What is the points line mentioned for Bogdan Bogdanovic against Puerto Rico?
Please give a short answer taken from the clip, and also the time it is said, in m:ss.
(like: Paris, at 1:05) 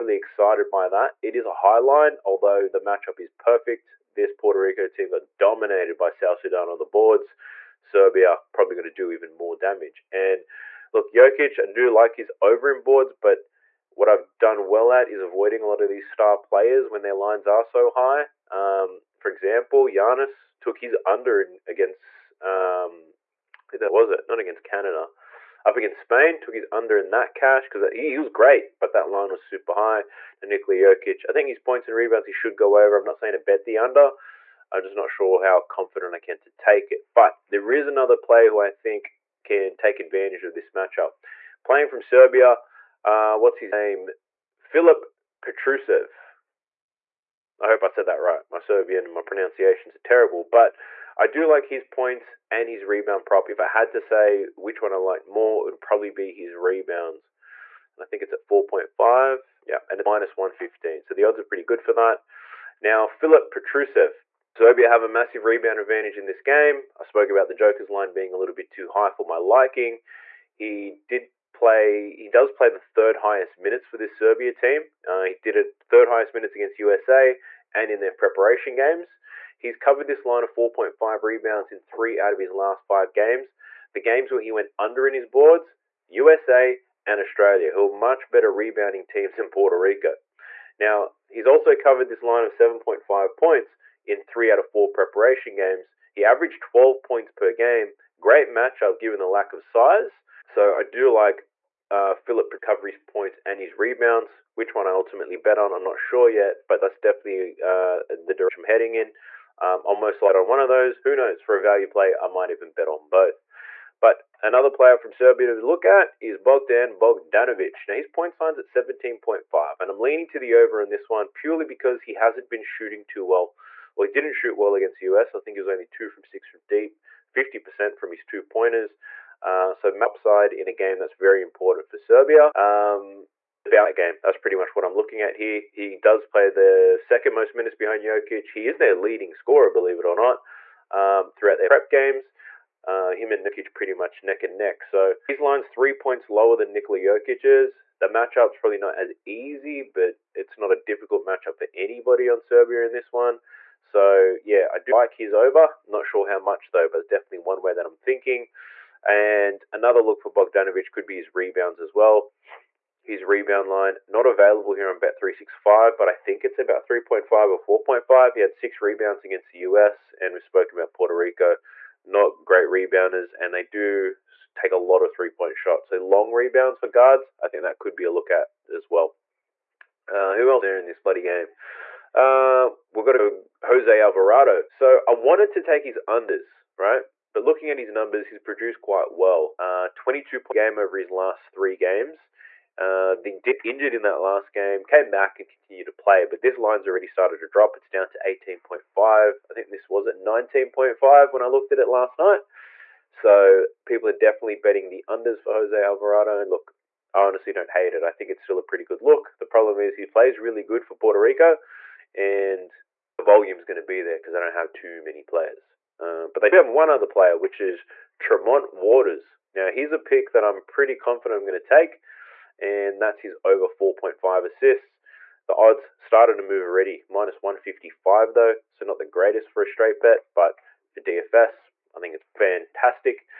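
17.5, at 1:58.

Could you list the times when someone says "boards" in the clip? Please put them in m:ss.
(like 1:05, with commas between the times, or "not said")
0:06, 0:12, 1:25.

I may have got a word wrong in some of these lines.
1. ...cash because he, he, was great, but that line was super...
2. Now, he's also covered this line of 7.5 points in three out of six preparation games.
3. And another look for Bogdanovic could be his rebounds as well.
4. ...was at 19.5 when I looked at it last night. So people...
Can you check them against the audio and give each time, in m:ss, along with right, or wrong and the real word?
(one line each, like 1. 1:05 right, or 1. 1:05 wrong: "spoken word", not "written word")
1. 0:27 right
2. 1:30 wrong: "four", not "six"
3. 2:39 right
4. 3:19 right.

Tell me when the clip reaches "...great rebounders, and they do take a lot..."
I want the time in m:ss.
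2:52.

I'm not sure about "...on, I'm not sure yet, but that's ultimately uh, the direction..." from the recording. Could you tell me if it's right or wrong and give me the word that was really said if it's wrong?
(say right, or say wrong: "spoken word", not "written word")
wrong: "definitely", not "ultimately".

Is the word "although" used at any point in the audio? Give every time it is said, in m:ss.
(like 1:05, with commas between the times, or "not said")
0:02.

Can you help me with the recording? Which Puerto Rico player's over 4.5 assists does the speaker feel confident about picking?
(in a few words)
Tremont Waters.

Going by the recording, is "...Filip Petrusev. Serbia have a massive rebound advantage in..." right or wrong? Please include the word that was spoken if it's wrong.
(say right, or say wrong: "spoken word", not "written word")
right.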